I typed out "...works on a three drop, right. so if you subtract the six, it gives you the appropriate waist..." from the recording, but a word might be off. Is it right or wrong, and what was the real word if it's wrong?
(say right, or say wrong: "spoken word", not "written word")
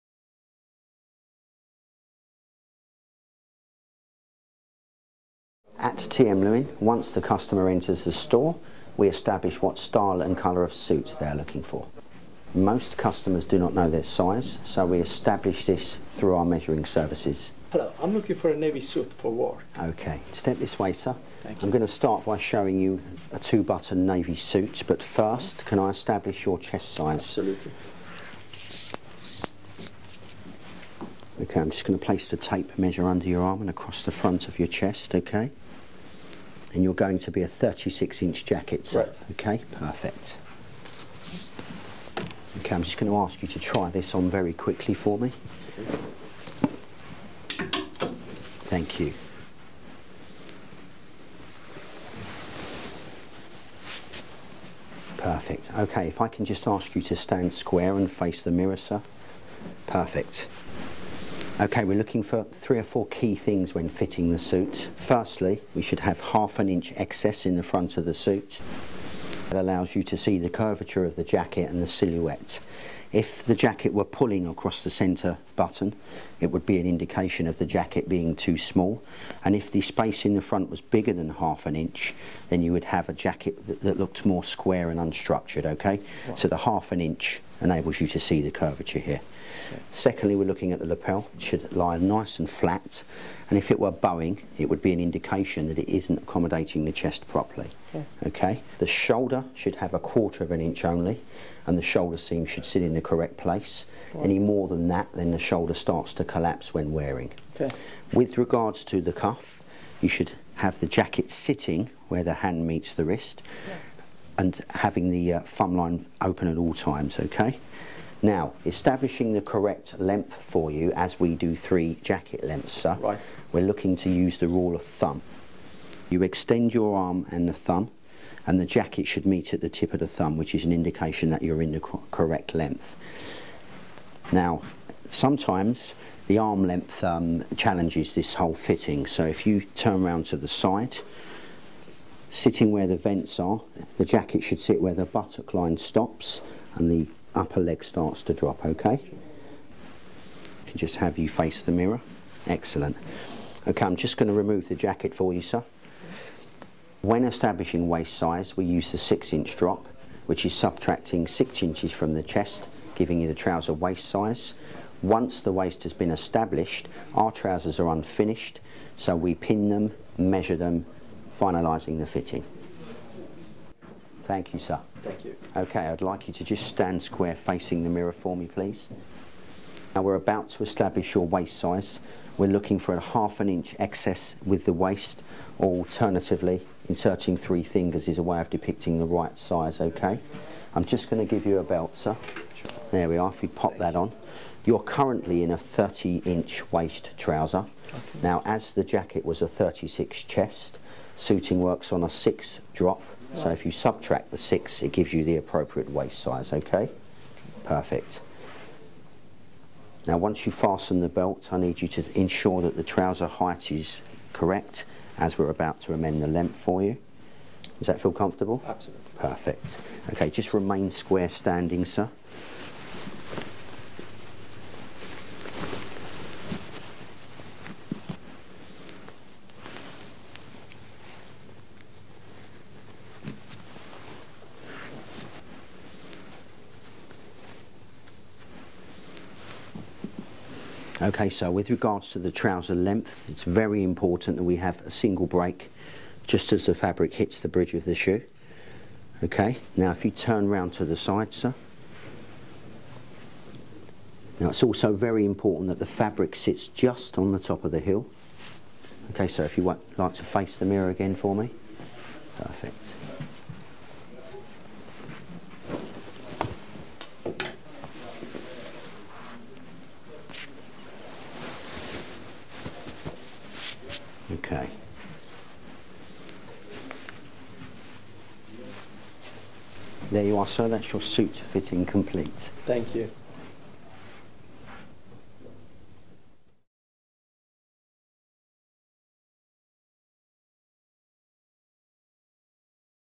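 wrong: "six", not "three".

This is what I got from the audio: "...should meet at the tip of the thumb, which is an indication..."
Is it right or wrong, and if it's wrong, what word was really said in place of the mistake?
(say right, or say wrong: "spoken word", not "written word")
right.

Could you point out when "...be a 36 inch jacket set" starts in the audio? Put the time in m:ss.
0:37.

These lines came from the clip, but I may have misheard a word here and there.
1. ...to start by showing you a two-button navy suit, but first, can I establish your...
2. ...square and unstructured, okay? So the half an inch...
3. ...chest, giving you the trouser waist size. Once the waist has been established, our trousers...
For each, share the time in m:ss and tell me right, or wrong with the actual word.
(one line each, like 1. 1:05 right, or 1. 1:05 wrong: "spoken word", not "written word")
1. 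0:21 right
2. 1:24 right
3. 2:42 right.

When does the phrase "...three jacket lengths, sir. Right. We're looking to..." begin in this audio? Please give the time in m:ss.
2:01.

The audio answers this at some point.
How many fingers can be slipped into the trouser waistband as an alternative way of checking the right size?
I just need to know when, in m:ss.
3:07.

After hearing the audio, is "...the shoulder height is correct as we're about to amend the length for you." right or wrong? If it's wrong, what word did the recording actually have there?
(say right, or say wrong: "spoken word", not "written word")
wrong: "trouser", not "shoulder".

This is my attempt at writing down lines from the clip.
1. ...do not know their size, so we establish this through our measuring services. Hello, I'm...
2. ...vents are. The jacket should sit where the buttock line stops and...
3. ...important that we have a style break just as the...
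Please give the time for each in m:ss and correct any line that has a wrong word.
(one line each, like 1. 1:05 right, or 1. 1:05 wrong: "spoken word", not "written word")
1. 0:13 right
2. 2:22 right
3. 4:03 wrong: "single", not "style".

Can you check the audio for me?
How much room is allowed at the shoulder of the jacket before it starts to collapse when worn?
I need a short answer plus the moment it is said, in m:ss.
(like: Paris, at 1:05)
a quarter of an inch, at 1:39.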